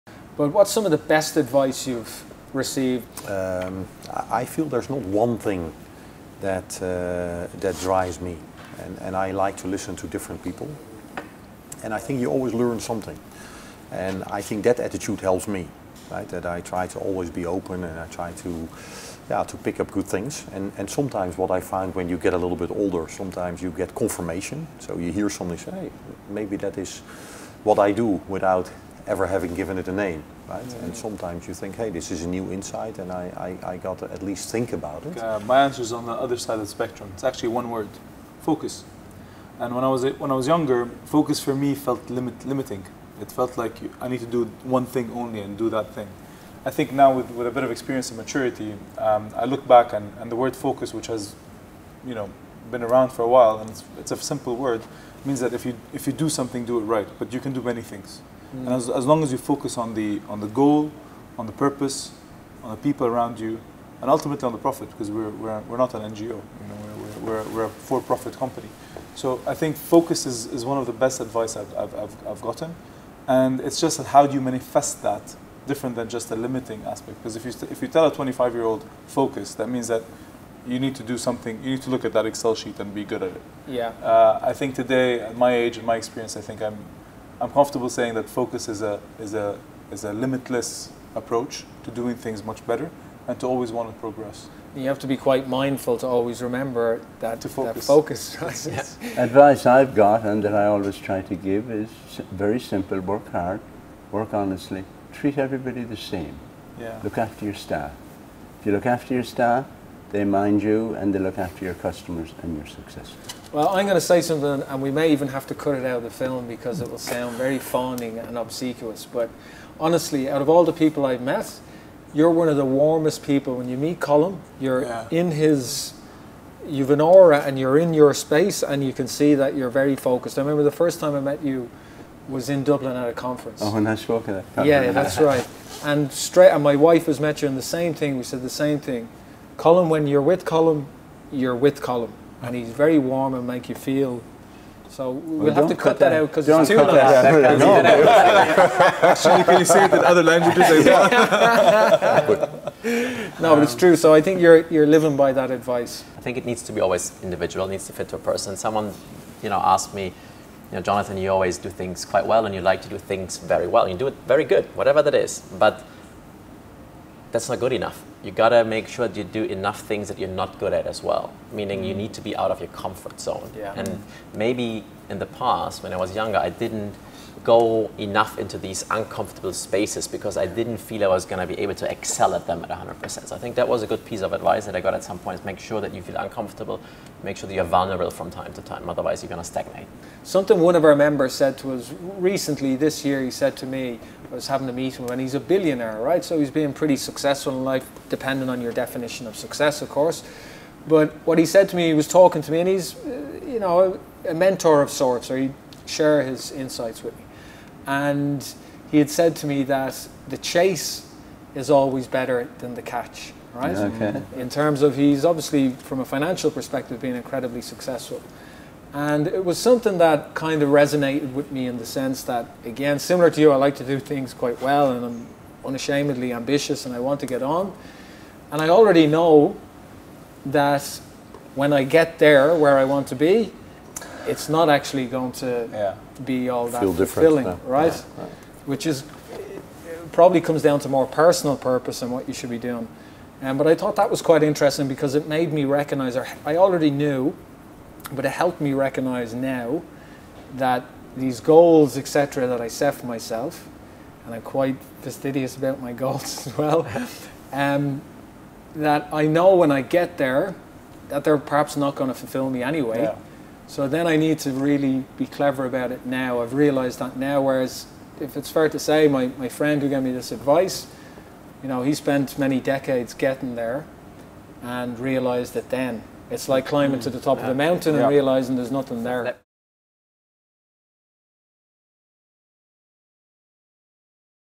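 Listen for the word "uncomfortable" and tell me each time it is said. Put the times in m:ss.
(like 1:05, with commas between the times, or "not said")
2:58, 3:06.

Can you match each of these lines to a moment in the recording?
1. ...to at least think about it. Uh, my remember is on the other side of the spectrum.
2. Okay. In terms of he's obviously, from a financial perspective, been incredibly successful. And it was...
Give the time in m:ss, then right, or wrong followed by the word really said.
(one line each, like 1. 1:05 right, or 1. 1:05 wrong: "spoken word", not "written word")
1. 0:33 wrong: "answer", not "remember"
2. 3:33 right.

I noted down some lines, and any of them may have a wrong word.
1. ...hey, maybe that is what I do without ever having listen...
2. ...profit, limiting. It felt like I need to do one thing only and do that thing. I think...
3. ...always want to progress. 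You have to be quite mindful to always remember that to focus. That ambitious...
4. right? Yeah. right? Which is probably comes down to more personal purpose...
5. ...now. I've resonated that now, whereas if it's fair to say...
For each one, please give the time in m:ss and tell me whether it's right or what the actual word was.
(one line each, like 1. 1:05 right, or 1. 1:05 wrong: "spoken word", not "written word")
1. 0:25 wrong: "given", not "listen"
2. 0:42 wrong: "limit", not "profit"
3. 1:33 wrong: "focus", not "ambitious"
4. 3:57 right
5. 4:26 wrong: "realized", not "resonated".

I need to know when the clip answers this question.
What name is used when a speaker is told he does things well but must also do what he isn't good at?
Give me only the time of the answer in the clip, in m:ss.
2:40.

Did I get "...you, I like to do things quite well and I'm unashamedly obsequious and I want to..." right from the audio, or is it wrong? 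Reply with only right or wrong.
wrong.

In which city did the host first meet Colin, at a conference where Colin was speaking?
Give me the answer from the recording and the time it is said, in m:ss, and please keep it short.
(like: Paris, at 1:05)
Dublin, at 2:12.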